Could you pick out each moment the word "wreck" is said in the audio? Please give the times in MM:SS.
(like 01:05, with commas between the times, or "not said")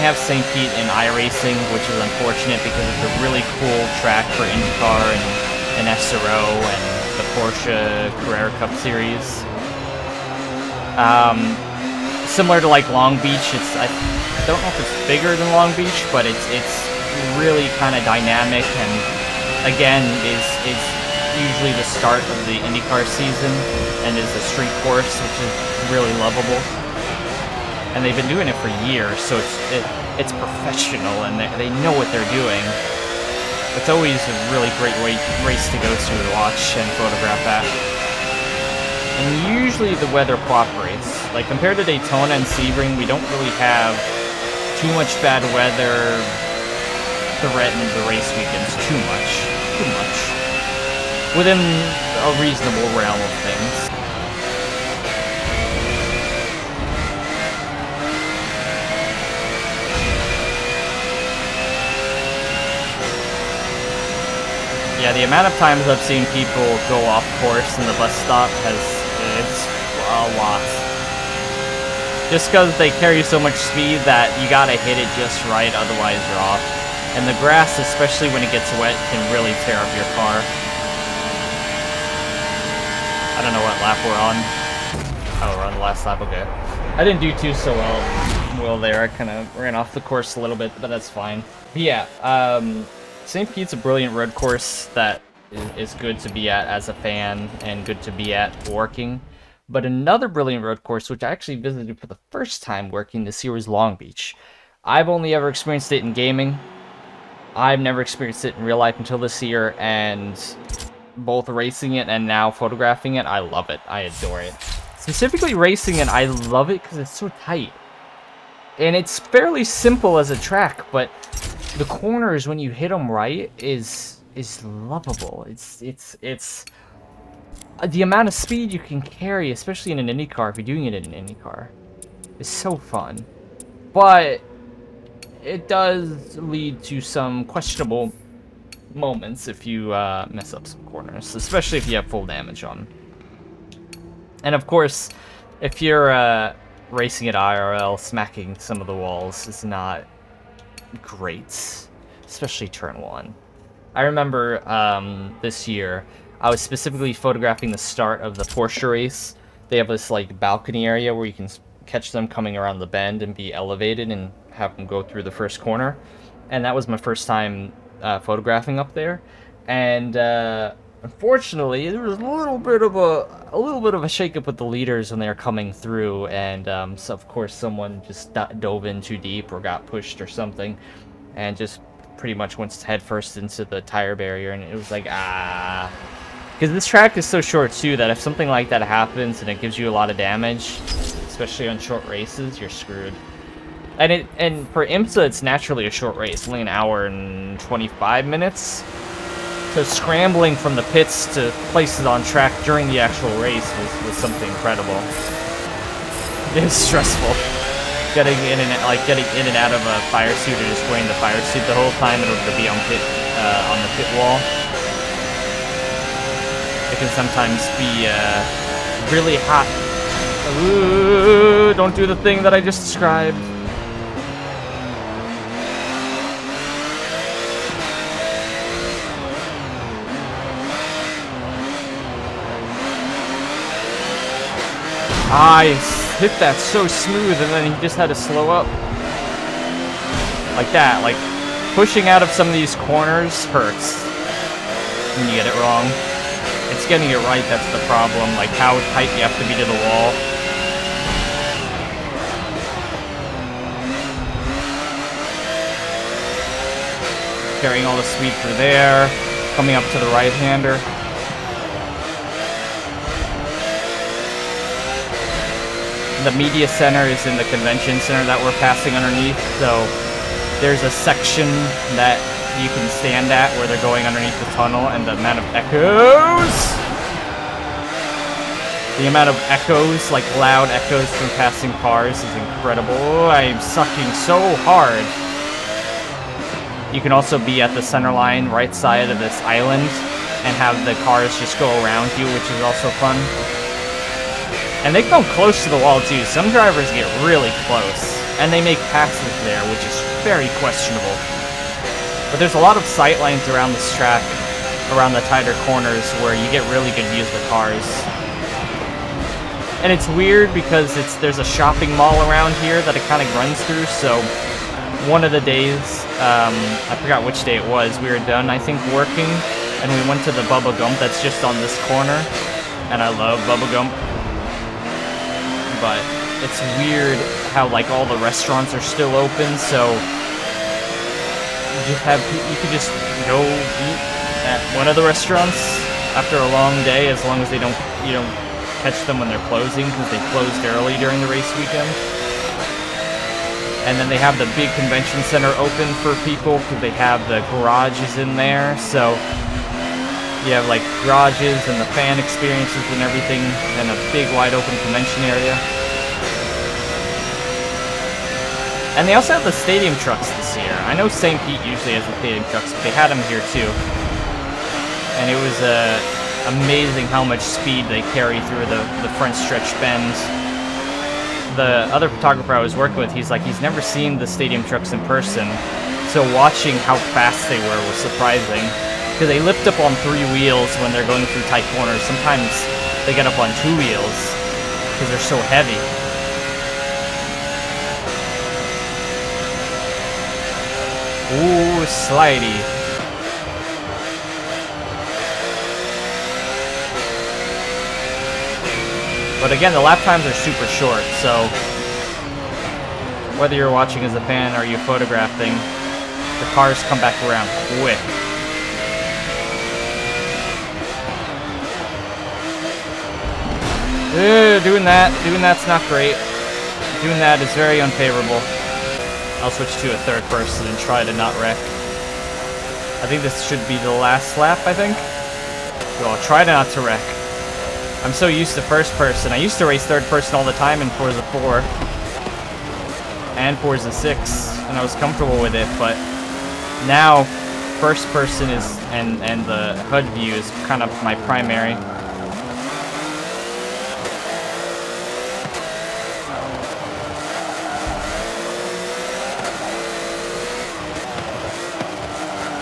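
07:01, 07:06.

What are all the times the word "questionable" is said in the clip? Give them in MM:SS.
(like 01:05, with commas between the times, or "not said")
02:17, 05:00.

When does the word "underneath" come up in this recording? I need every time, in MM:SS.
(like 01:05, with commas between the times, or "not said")
04:28, 04:34.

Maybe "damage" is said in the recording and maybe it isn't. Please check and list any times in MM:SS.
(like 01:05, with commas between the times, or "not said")
02:22, 03:10.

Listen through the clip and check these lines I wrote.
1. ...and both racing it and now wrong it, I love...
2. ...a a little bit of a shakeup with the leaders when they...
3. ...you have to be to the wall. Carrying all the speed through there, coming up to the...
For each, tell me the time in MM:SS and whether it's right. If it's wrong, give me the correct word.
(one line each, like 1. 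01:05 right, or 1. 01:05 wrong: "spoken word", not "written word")
1. 01:49 wrong: "photographing", not "wrong"
2. 02:52 right
3. 04:09 right.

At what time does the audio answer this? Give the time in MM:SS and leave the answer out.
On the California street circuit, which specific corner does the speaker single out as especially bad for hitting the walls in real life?
02:32.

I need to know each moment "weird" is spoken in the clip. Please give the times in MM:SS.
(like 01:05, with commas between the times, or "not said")
05:10, 05:26.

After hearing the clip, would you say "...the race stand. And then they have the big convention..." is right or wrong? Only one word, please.
wrong.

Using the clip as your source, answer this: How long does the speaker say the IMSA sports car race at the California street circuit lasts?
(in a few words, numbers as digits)
1 hour 25 minutes.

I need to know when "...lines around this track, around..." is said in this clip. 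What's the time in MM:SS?
05:03.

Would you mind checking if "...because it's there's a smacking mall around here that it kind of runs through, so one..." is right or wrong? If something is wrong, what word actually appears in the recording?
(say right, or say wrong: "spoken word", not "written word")
wrong: "shopping", not "smacking".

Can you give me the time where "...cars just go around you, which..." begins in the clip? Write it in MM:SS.
04:51.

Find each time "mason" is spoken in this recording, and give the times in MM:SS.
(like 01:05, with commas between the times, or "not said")
not said.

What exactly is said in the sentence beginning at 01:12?
Just because they carry so much speed that you gotta hit it just right, otherwise you're off.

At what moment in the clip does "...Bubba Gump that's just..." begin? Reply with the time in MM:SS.
05:20.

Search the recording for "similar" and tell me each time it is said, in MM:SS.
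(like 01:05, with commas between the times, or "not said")
00:12.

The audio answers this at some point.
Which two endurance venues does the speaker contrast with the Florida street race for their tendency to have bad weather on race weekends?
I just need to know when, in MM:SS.
00:41.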